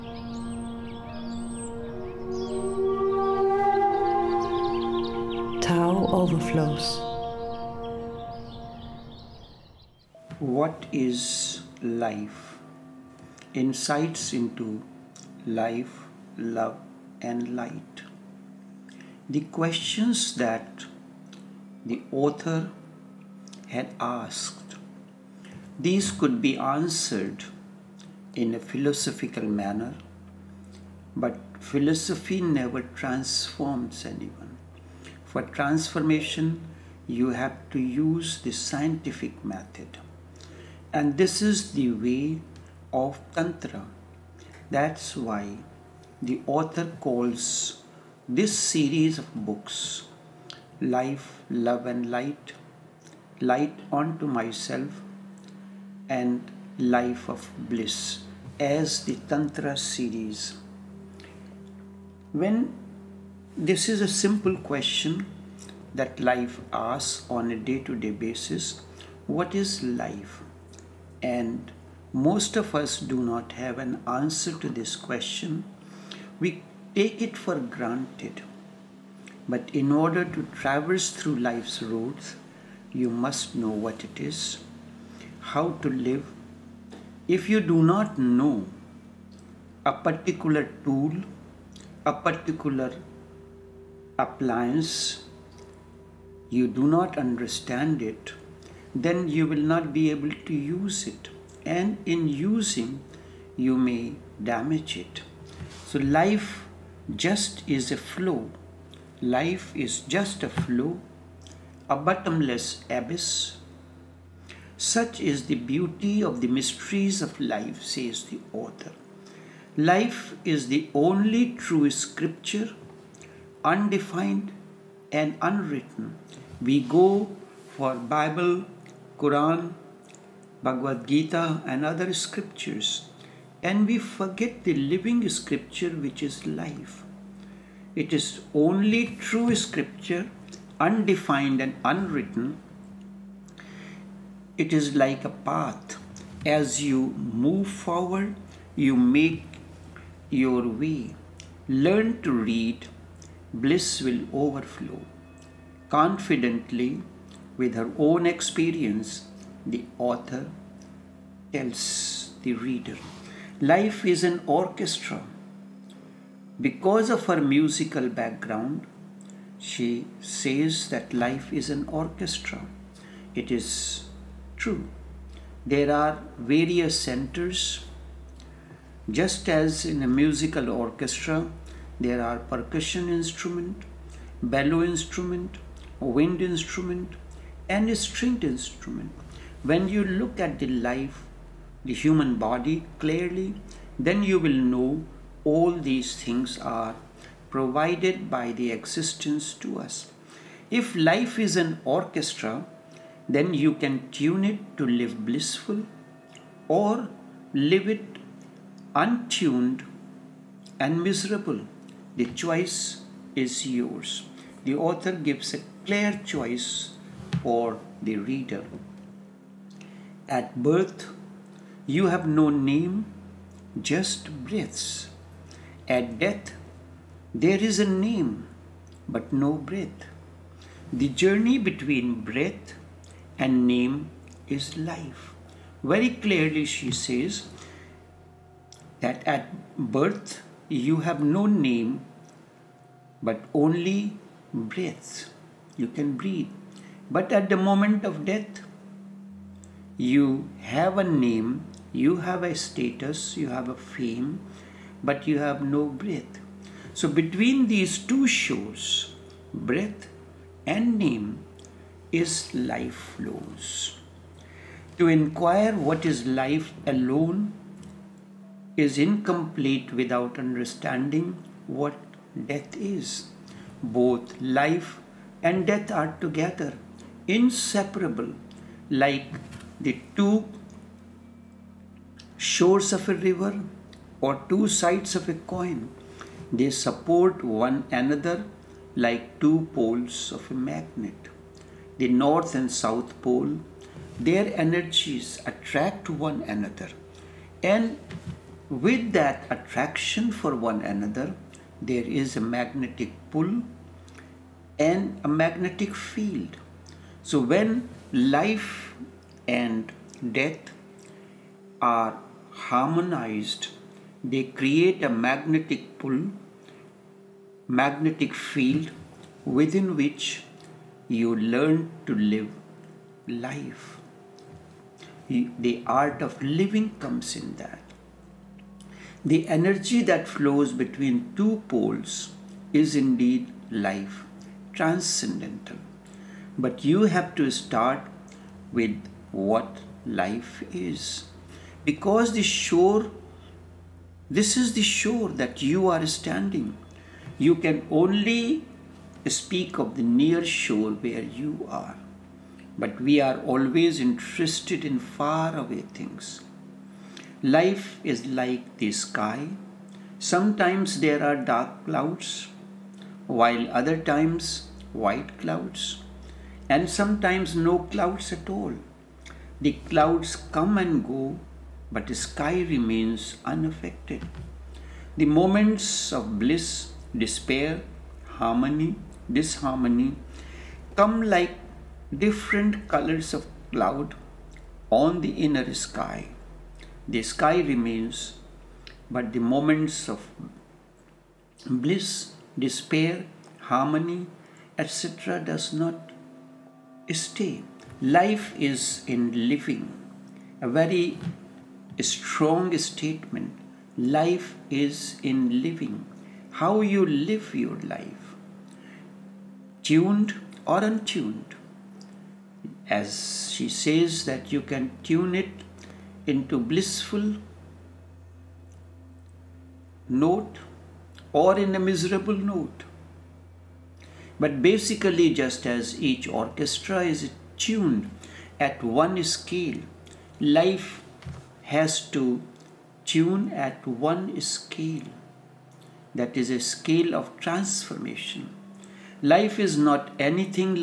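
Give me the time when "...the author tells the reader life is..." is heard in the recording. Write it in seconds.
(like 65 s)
159 s.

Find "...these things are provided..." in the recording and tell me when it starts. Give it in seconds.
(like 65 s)
195 s.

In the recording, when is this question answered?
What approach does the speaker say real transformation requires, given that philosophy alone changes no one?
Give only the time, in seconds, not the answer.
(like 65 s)
38 s.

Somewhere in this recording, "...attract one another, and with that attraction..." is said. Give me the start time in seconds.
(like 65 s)
295 s.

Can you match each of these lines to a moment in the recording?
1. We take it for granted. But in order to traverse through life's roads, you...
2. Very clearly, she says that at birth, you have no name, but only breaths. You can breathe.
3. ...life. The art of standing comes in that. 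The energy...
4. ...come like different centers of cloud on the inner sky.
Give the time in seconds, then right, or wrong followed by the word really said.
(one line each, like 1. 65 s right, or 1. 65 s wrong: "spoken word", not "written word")
1. 76 s right
2. 235 s right
3. 323 s wrong: "living", not "standing"
4. 380 s wrong: "colors", not "centers".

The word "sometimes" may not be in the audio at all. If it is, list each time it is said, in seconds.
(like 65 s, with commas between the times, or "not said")
360 s, 366 s.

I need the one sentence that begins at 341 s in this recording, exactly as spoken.
Because the shore, this is the shore that you are standing.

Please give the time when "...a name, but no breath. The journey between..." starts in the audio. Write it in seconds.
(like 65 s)
227 s.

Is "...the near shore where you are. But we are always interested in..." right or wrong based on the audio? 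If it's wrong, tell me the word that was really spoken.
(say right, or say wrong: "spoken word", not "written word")
right.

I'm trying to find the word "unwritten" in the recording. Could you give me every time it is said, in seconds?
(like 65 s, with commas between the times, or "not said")
125 s, 141 s.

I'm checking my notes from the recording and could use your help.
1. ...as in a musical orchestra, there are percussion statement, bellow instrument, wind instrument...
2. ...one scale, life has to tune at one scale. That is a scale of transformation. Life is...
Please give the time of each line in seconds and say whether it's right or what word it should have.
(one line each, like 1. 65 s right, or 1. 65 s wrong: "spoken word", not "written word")
1. 179 s wrong: "instrument", not "statement"
2. 428 s right.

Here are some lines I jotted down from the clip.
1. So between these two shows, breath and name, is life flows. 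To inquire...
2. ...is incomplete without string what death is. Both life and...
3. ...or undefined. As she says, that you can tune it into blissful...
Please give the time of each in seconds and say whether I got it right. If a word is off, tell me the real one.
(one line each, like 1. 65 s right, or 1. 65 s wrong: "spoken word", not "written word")
1. 256 s right
2. 268 s wrong: "understanding", not "string"
3. 410 s wrong: "untuned", not "undefined".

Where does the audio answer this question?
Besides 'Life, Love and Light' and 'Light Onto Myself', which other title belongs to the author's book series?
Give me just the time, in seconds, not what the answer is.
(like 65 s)
56 s.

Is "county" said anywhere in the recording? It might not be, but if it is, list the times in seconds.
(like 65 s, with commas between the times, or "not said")
not said.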